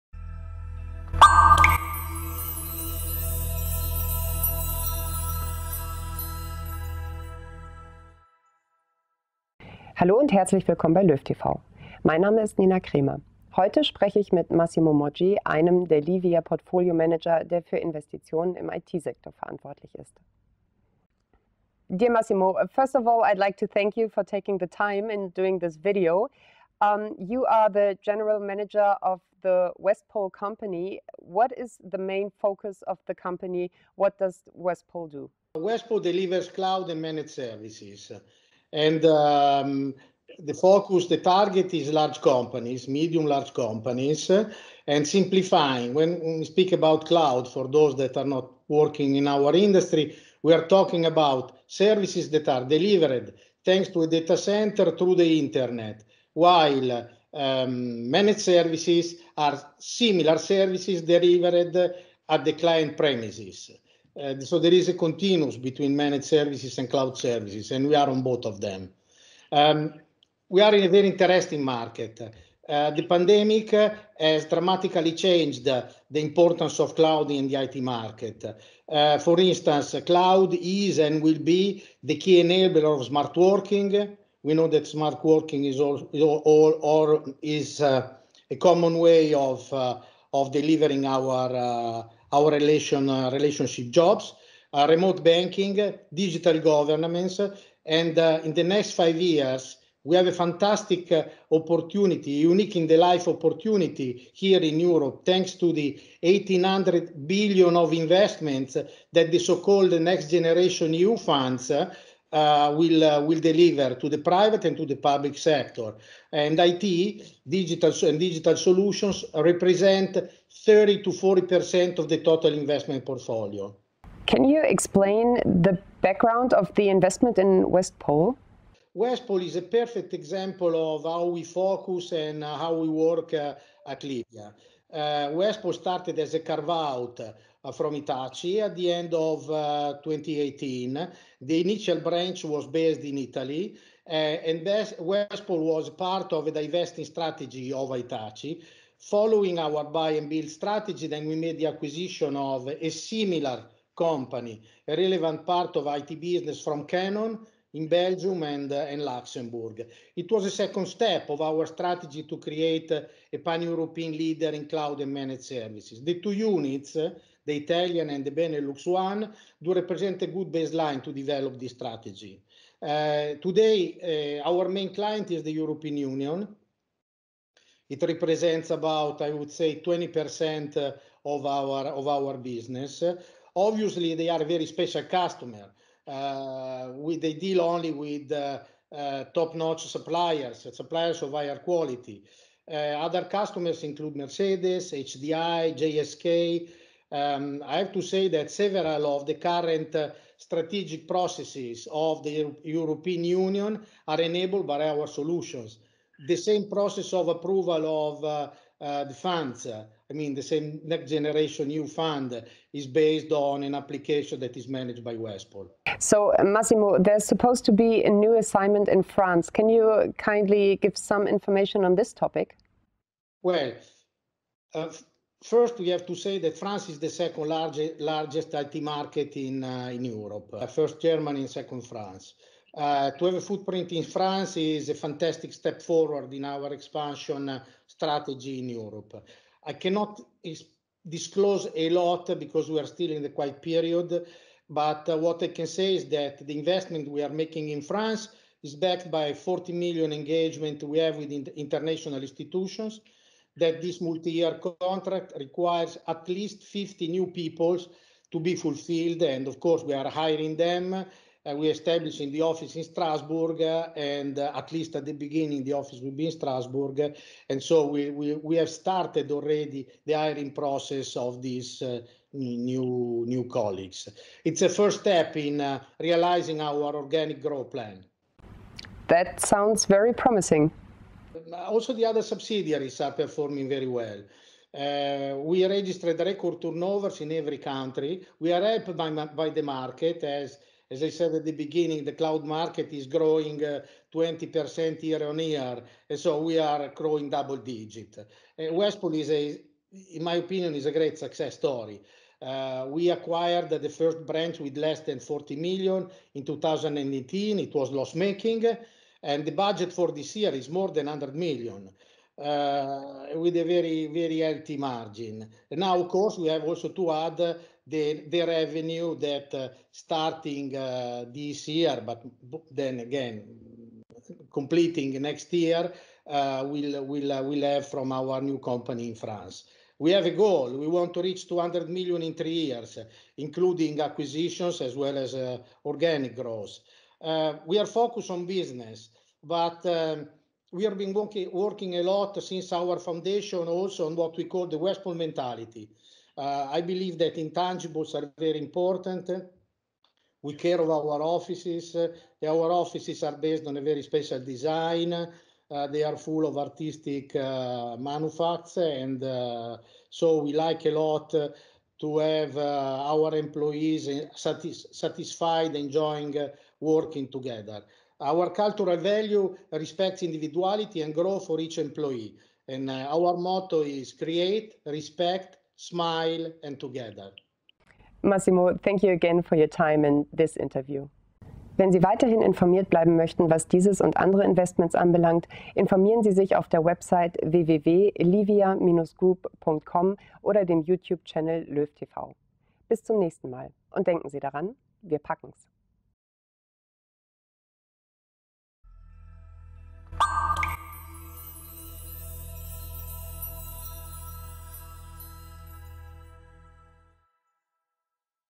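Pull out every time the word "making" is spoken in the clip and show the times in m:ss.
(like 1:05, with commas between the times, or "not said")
4:07, 5:07.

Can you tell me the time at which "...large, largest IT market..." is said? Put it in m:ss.
3:47.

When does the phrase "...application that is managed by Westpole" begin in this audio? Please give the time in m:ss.
3:33.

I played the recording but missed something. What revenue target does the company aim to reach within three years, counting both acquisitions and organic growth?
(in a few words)
200 million.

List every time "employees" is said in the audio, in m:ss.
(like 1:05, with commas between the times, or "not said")
6:03, 6:11.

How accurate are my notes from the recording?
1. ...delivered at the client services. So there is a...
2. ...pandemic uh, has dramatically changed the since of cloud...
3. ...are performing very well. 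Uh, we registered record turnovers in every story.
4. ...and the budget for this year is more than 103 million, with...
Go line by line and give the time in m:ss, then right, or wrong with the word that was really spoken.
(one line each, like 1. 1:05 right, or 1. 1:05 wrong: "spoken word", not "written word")
1. 1:01 wrong: "premises", not "services"
2. 1:13 wrong: "importance", not "since"
3. 4:43 wrong: "country", not "story"
4. 5:09 wrong: "100", not "103".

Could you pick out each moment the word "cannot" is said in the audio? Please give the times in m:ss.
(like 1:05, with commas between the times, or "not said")
3:59.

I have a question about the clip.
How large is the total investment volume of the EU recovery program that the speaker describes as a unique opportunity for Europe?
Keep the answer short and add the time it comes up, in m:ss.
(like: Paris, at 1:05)
1800 billion, at 1:46.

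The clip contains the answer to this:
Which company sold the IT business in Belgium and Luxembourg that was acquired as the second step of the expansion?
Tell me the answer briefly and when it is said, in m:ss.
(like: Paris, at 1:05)
Canon, at 2:36.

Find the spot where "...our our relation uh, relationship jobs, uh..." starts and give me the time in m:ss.
1:31.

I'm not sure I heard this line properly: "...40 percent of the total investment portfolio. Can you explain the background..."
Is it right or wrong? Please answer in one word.
right.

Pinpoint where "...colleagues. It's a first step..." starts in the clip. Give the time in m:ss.
4:33.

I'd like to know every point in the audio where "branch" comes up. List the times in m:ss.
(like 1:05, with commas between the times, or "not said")
2:22, 5:04.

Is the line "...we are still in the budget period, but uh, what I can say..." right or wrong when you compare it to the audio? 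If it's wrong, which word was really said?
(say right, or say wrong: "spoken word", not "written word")
wrong: "quiet", not "budget".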